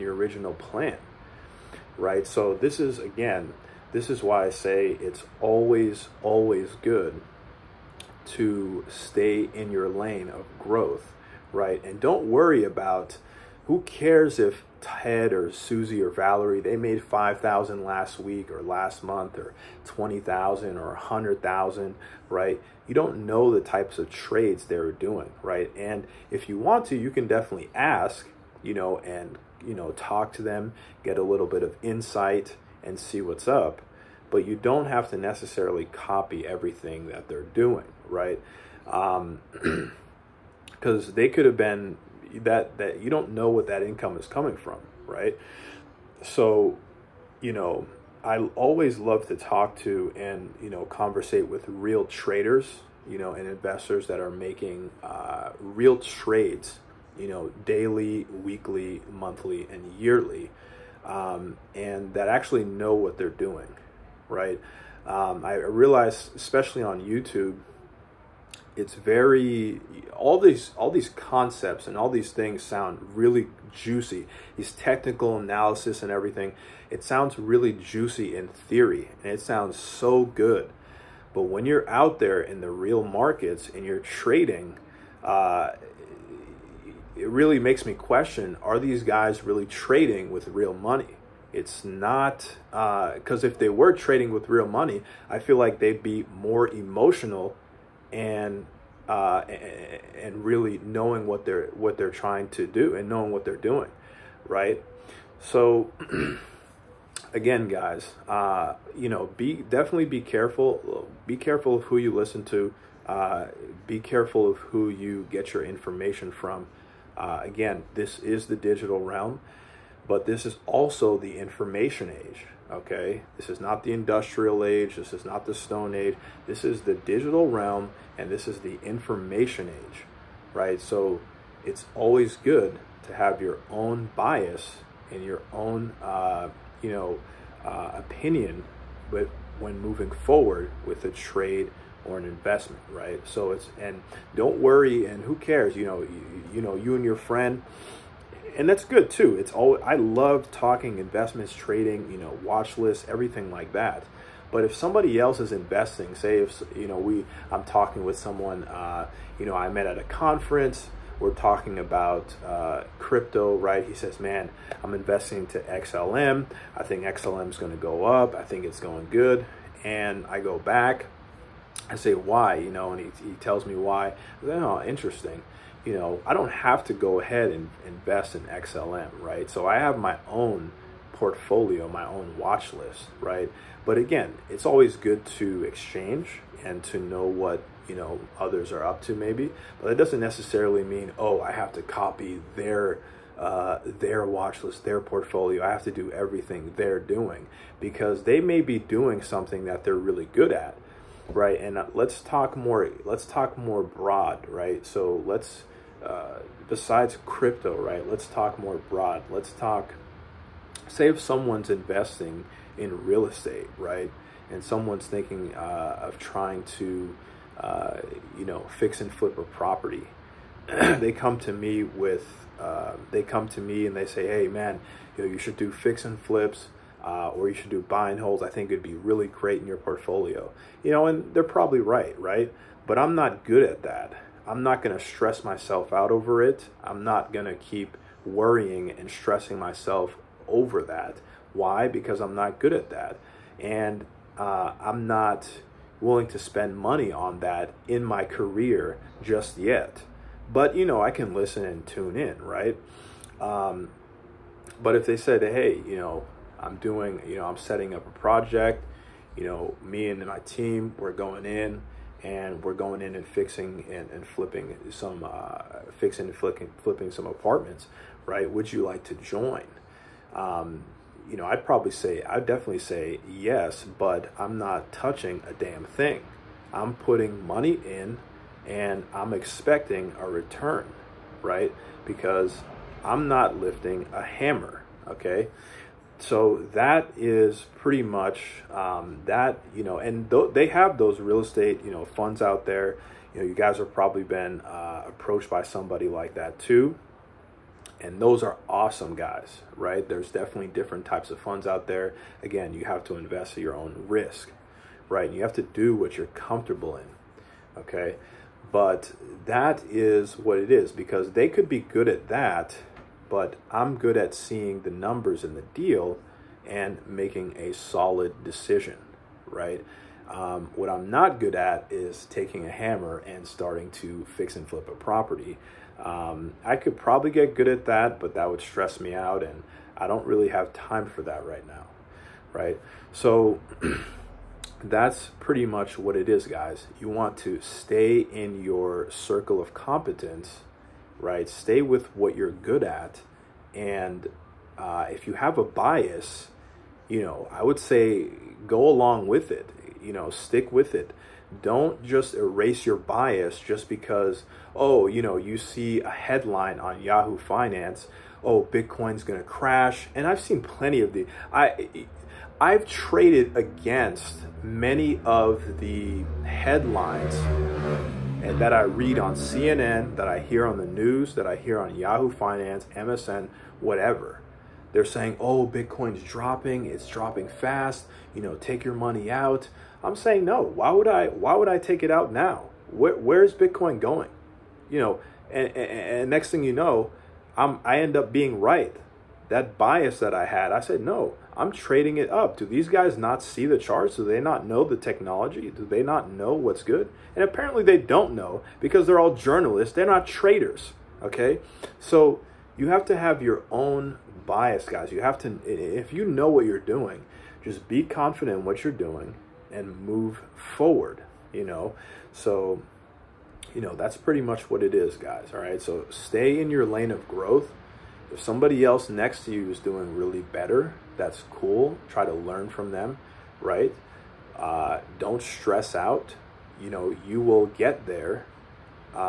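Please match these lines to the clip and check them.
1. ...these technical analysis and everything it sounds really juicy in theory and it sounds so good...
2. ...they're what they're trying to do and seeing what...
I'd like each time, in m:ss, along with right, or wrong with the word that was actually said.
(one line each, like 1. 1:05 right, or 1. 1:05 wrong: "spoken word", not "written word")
1. 1:14 right
2. 1:41 wrong: "knowing", not "seeing".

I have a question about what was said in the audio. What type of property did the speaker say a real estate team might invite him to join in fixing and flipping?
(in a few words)
apartments.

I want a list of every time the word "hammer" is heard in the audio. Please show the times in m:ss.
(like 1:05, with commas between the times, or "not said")
4:44, 5:22.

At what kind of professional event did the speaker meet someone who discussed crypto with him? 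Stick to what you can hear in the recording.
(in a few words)
a conference.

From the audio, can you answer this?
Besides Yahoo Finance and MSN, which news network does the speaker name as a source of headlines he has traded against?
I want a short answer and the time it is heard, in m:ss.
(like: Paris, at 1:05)
CNN, at 6:09.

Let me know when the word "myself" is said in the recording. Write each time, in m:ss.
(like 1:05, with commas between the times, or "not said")
3:55, 3:59.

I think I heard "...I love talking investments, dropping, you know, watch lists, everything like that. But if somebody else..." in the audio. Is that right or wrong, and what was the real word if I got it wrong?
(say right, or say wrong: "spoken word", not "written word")
wrong: "trading", not "dropping".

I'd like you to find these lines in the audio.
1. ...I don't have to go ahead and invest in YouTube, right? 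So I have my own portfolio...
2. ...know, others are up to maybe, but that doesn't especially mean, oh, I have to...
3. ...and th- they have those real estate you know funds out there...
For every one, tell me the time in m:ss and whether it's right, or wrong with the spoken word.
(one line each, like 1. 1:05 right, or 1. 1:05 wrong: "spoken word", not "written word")
1. 2:56 wrong: "XLM", not "YouTube"
2. 3:07 wrong: "necessarily", not "especially"
3. 4:49 right.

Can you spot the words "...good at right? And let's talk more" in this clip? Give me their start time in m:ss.
3:20.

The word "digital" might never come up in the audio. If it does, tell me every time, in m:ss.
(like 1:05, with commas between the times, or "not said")
1:58, 2:06.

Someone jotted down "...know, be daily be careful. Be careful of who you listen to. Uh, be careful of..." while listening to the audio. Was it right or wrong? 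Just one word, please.
wrong.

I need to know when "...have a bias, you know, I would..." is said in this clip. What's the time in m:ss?
5:45.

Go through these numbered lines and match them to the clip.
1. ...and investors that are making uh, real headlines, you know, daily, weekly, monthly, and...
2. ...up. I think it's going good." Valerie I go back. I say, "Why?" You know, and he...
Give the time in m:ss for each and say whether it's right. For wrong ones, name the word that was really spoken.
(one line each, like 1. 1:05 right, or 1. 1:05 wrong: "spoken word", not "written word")
1. 0:53 wrong: "trades", not "headlines"
2. 2:48 wrong: "And", not "Valerie".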